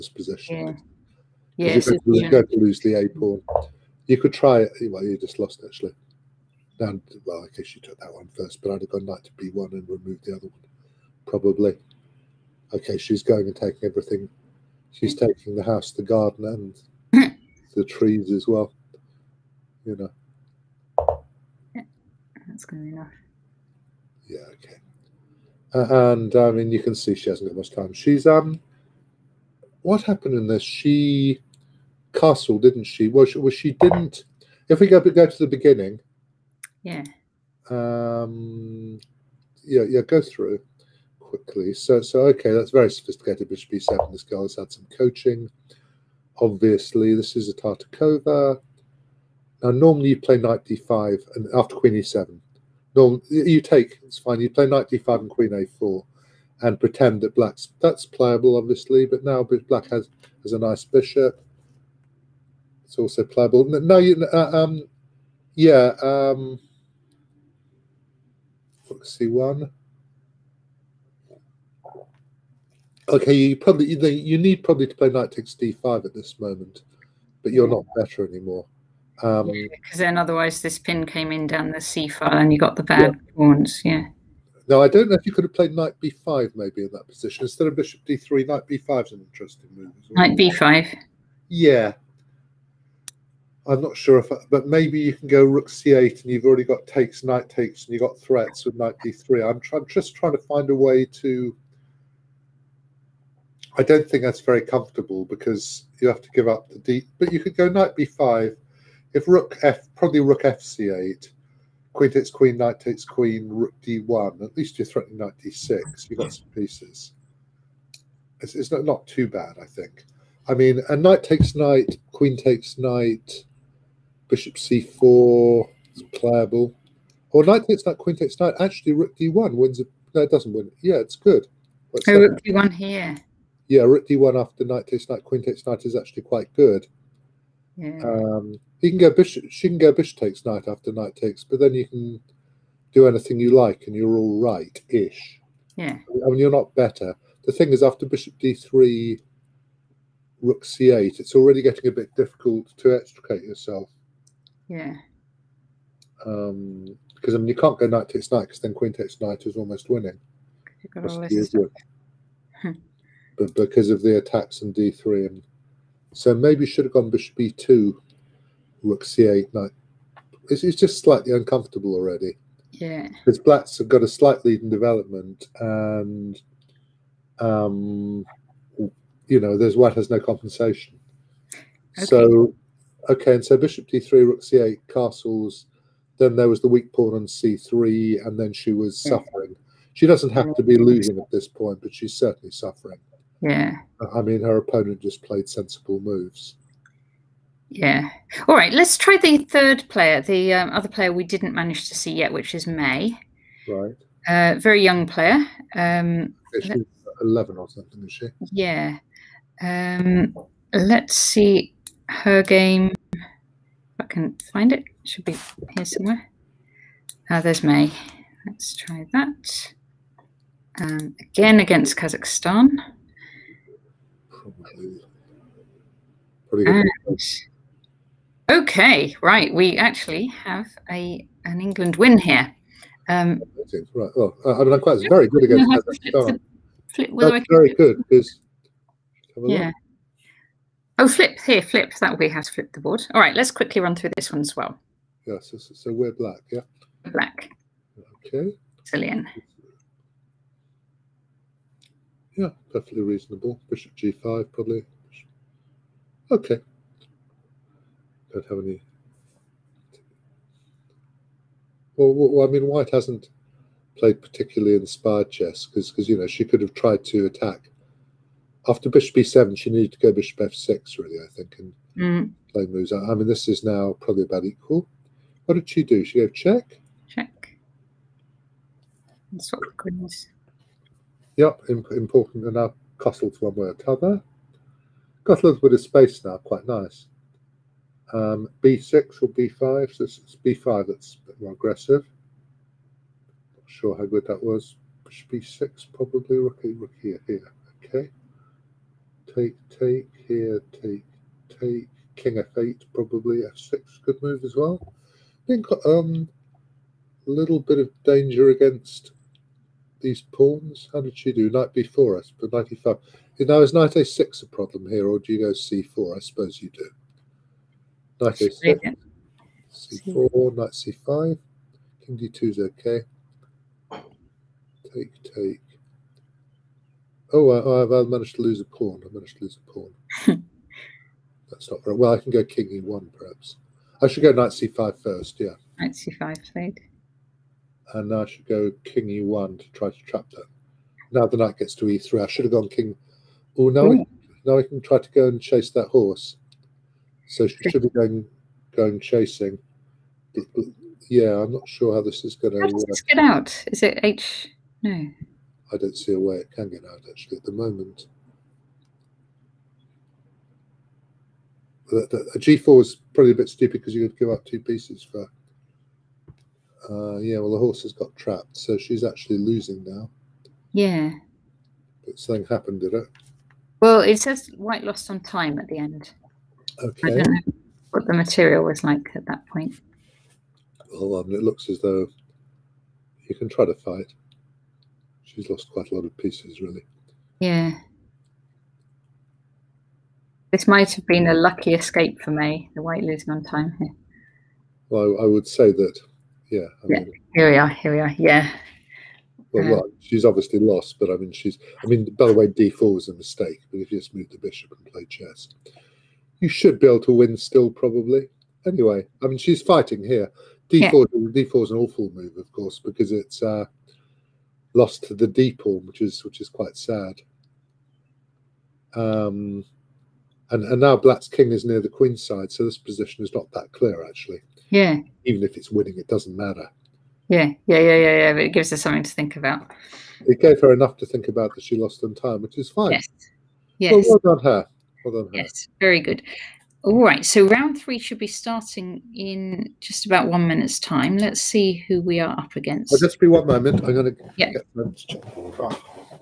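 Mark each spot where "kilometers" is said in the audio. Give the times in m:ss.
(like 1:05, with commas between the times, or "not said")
not said.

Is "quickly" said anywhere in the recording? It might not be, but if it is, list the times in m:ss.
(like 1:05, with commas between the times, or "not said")
0:41, 4:03.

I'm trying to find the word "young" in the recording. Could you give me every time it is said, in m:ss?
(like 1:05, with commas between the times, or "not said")
3:24.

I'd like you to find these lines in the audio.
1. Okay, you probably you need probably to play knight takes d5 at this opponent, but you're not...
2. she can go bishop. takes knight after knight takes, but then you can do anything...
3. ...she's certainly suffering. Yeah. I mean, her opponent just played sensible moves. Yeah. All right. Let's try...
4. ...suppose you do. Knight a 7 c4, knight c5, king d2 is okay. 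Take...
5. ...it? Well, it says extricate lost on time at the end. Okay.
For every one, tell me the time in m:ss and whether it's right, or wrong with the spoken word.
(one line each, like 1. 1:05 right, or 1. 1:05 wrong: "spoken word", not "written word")
1. 1:13 wrong: "moment", not "opponent"
2. 2:19 right
3. 3:11 right
4. 5:16 right
5. 6:12 wrong: "white", not "extricate".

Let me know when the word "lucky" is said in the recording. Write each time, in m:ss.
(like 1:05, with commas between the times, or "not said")
6:31.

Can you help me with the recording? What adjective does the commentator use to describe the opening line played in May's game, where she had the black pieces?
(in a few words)
Brazilian.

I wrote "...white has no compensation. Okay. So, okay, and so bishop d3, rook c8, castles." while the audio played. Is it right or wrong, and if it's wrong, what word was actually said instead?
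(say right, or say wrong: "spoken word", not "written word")
right.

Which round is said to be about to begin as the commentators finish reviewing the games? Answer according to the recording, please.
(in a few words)
Round 3.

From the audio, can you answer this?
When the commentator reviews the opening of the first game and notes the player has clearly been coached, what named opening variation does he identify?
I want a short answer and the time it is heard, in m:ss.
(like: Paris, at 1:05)
Tartakower, at 0:47.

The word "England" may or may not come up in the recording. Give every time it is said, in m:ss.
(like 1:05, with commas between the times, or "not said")
3:51.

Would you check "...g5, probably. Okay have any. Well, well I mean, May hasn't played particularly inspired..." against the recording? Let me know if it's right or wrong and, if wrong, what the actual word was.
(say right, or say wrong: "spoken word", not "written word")
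wrong: "White", not "May".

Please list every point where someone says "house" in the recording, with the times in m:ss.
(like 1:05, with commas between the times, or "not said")
0:15.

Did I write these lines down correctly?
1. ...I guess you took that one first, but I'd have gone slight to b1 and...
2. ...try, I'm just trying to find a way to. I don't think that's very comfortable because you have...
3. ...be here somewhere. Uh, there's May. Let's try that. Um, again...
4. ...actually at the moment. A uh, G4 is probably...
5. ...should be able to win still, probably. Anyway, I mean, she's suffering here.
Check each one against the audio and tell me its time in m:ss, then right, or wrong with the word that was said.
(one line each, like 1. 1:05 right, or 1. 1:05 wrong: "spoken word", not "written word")
1. 0:07 wrong: "knight", not "slight"
2. 1:39 right
3. 3:35 right
4. 5:57 right
5. 6:46 wrong: "fighting", not "suffering".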